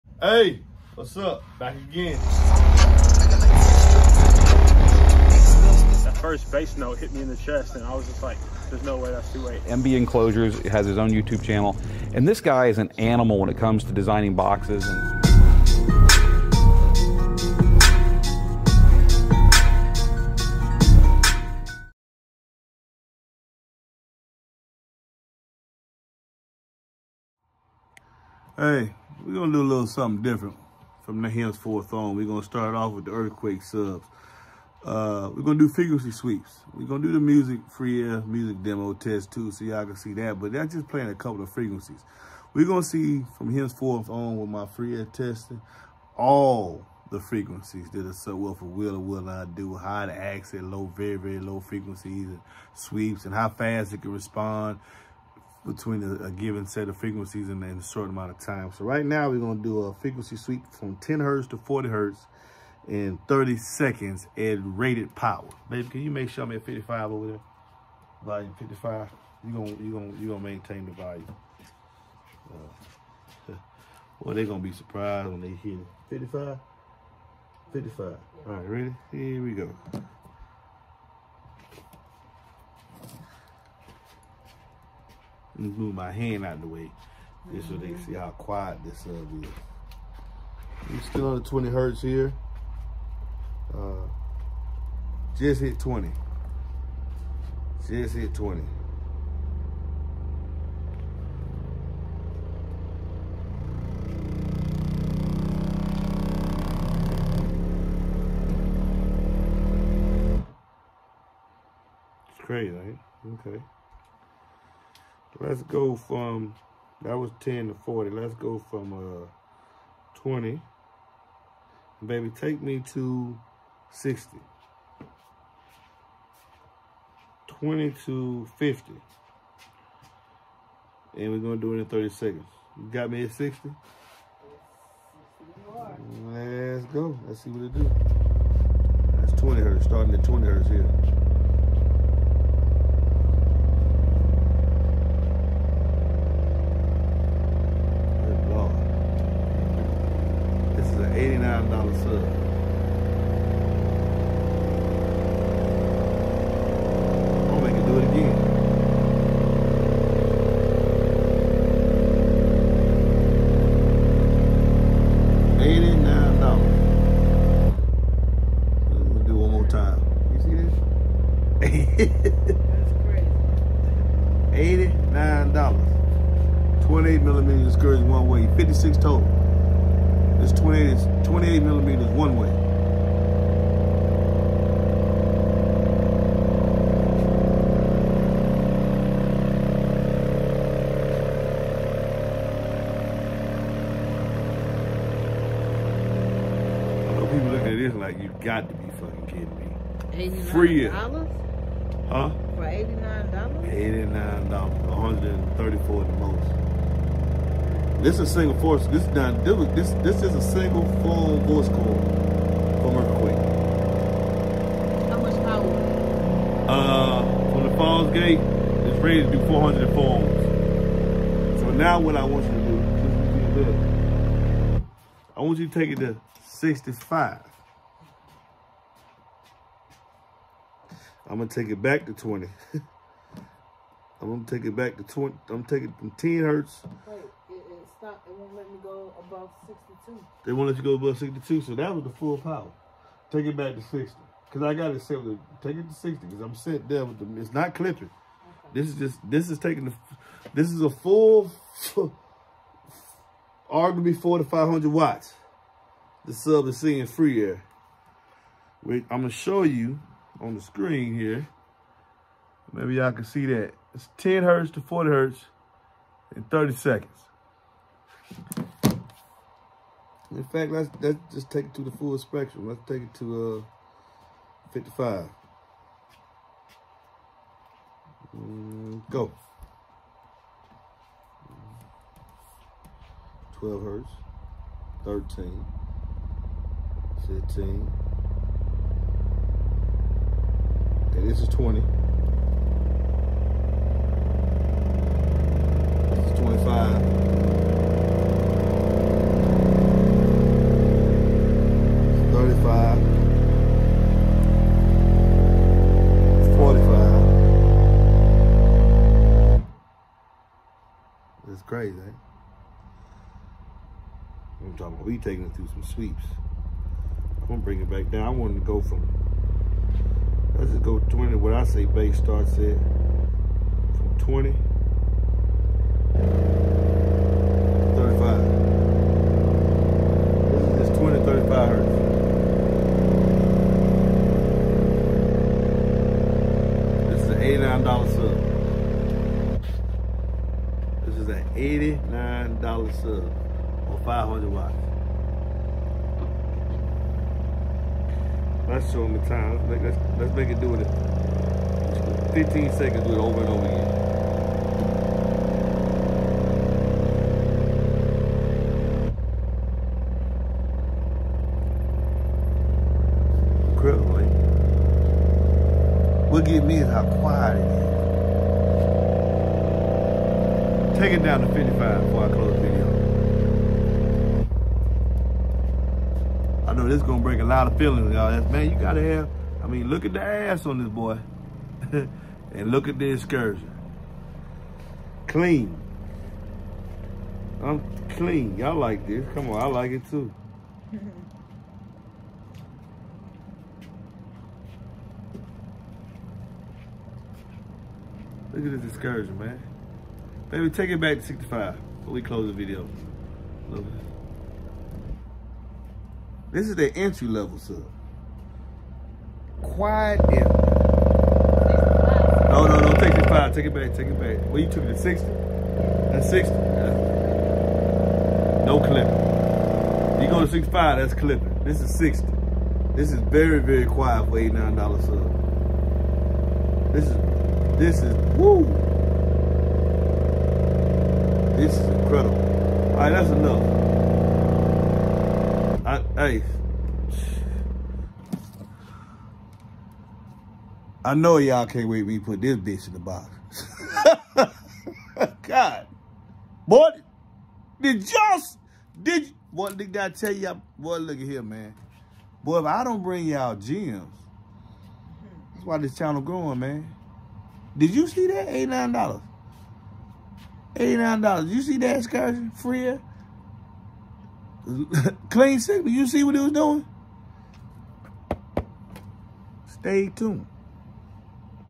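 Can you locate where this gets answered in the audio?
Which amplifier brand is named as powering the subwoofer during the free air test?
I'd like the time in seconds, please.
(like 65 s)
217 s.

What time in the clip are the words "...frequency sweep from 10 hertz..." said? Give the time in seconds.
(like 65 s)
59 s.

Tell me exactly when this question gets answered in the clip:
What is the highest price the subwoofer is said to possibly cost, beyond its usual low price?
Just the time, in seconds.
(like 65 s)
204 s.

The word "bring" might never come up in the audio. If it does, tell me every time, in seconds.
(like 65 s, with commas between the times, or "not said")
317 s, 453 s.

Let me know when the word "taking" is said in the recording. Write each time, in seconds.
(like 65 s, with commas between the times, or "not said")
235 s, 249 s, 315 s.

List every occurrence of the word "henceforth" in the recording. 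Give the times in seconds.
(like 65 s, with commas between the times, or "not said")
31 s, 43 s.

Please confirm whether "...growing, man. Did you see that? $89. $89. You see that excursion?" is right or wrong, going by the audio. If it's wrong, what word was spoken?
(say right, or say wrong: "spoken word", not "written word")
right.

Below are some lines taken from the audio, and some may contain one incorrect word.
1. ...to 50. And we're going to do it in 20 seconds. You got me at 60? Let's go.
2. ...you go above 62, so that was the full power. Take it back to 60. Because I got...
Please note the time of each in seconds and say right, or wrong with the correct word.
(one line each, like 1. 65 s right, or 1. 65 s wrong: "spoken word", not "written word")
1. 128 s wrong: "30", not "20"
2. 240 s right.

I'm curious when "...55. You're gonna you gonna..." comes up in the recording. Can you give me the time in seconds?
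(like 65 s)
68 s.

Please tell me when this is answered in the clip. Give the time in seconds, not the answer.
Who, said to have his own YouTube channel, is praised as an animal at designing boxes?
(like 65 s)
9 s.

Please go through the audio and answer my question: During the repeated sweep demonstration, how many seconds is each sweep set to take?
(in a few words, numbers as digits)
15 seconds.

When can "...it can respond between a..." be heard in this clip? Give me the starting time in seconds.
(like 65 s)
53 s.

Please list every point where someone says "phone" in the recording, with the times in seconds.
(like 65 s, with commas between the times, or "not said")
211 s, 219 s.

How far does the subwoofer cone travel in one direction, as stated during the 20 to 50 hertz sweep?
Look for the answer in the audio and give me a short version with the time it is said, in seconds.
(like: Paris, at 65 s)
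28 millimeters, at 181 s.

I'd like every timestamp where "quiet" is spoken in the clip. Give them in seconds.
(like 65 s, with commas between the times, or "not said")
88 s, 367 s, 409 s, 423 s.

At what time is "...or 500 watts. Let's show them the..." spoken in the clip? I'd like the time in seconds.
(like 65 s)
343 s.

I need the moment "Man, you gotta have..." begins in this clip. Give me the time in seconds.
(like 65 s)
378 s.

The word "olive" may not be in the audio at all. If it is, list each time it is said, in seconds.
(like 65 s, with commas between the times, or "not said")
not said.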